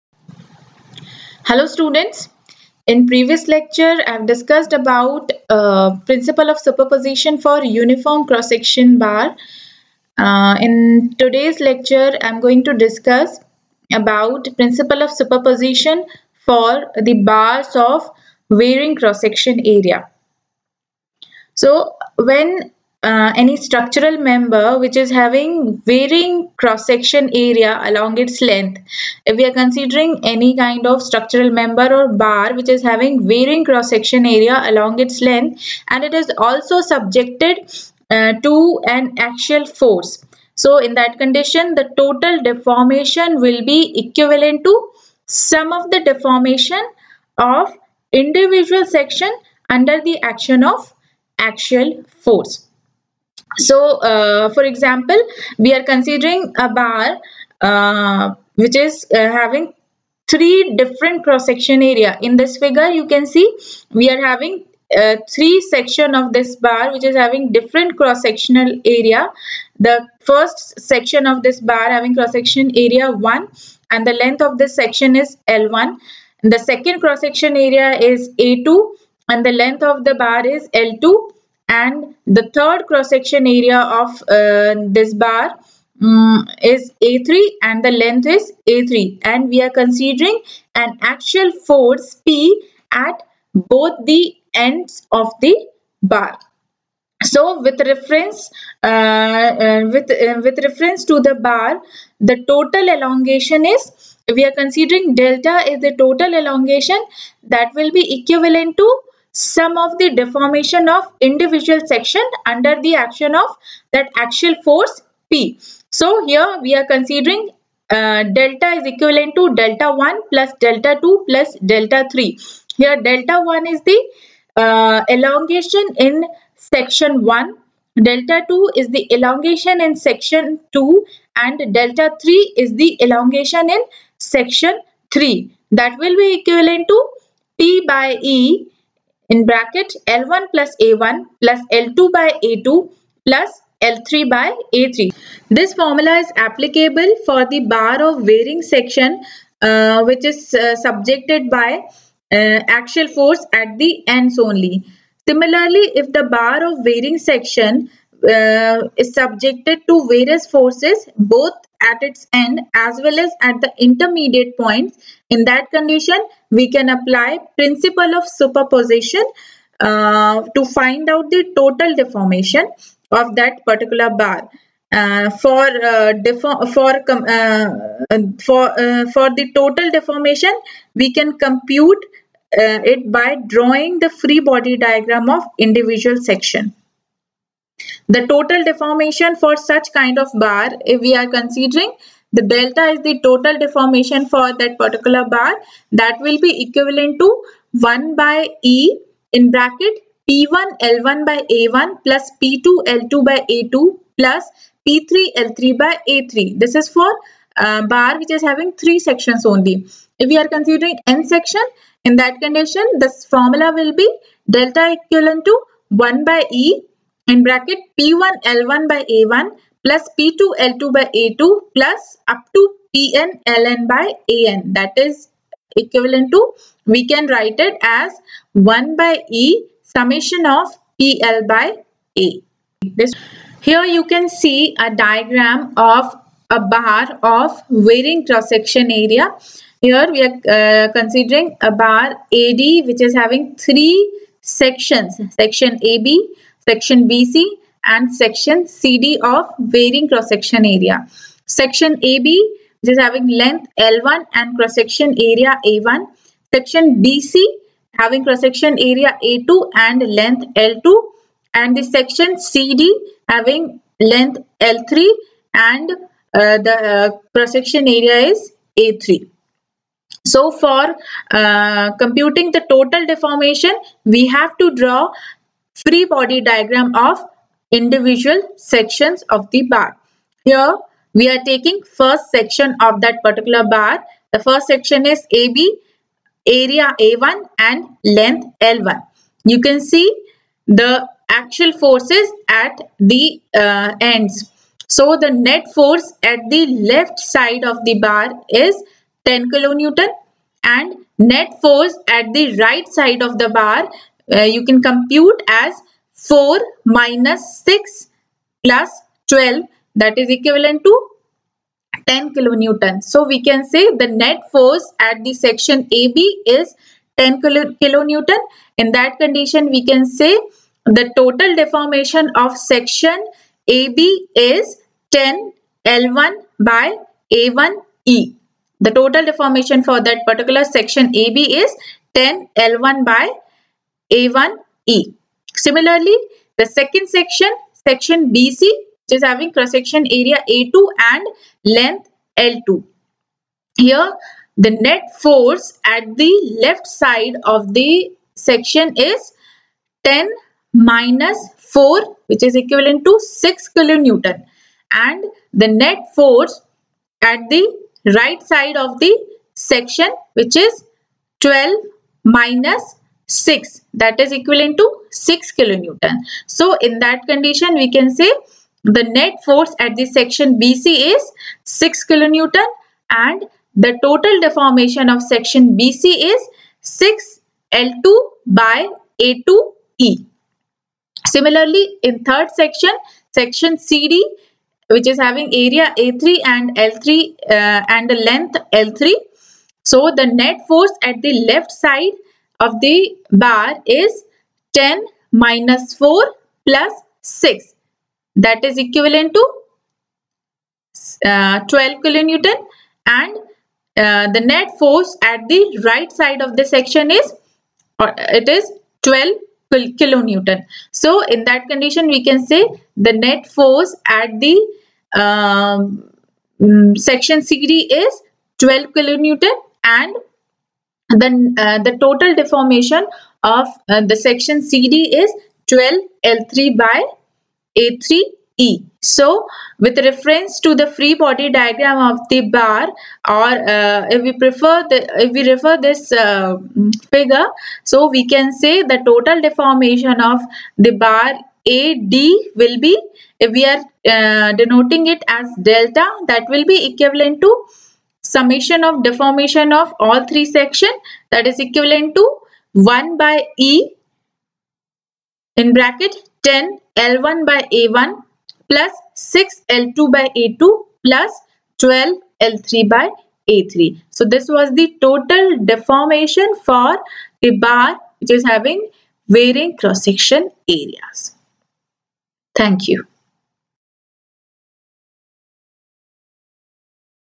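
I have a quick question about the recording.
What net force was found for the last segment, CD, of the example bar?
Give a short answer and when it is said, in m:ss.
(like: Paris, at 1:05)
12 kN, at 6:53.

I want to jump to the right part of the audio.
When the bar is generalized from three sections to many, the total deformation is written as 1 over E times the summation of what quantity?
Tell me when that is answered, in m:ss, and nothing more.
3:49.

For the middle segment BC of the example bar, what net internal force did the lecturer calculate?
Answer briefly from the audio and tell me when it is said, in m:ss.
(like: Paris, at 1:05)
6 kN, at 6:09.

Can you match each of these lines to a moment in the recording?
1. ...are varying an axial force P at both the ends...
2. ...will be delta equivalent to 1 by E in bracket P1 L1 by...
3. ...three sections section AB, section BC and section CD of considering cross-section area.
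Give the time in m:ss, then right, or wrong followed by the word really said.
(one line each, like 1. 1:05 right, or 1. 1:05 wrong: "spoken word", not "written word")
1. 1:29 wrong: "considering", not "varying"
2. 3:33 right
3. 4:03 wrong: "varying", not "considering".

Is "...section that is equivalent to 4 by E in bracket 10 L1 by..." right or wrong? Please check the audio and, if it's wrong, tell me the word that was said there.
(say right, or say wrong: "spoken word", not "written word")
wrong: "1", not "4".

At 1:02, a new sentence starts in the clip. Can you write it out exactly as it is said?
In this figure, you can see we are having uh, three section of this bar which is having different cross sectional area.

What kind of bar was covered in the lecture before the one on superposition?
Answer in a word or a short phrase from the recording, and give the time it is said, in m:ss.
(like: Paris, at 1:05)
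uniform cross-section bar, at 0:07.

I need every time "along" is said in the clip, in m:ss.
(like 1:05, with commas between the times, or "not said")
0:27, 0:34.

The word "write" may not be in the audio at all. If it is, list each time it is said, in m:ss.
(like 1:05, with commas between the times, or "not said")
3:47.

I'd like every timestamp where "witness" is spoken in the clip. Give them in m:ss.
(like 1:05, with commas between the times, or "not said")
not said.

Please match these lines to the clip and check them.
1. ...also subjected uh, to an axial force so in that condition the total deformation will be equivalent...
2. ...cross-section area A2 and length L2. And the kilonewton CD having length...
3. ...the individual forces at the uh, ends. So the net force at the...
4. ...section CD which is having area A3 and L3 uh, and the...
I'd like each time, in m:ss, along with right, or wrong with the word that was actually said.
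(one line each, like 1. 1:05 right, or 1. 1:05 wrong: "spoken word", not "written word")
1. 0:36 right
2. 4:18 wrong: "section", not "kilonewton"
3. 4:50 wrong: "axial", not "individual"
4. 6:23 right.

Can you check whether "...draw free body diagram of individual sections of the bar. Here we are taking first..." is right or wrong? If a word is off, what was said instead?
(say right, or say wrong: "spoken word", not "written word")
right.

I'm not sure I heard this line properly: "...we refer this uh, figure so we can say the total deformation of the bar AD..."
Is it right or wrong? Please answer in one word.
right.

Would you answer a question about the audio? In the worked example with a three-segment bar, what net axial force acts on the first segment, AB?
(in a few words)
10 kN.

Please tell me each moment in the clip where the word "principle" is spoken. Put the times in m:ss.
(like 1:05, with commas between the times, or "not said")
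0:06, 0:14, 2:47.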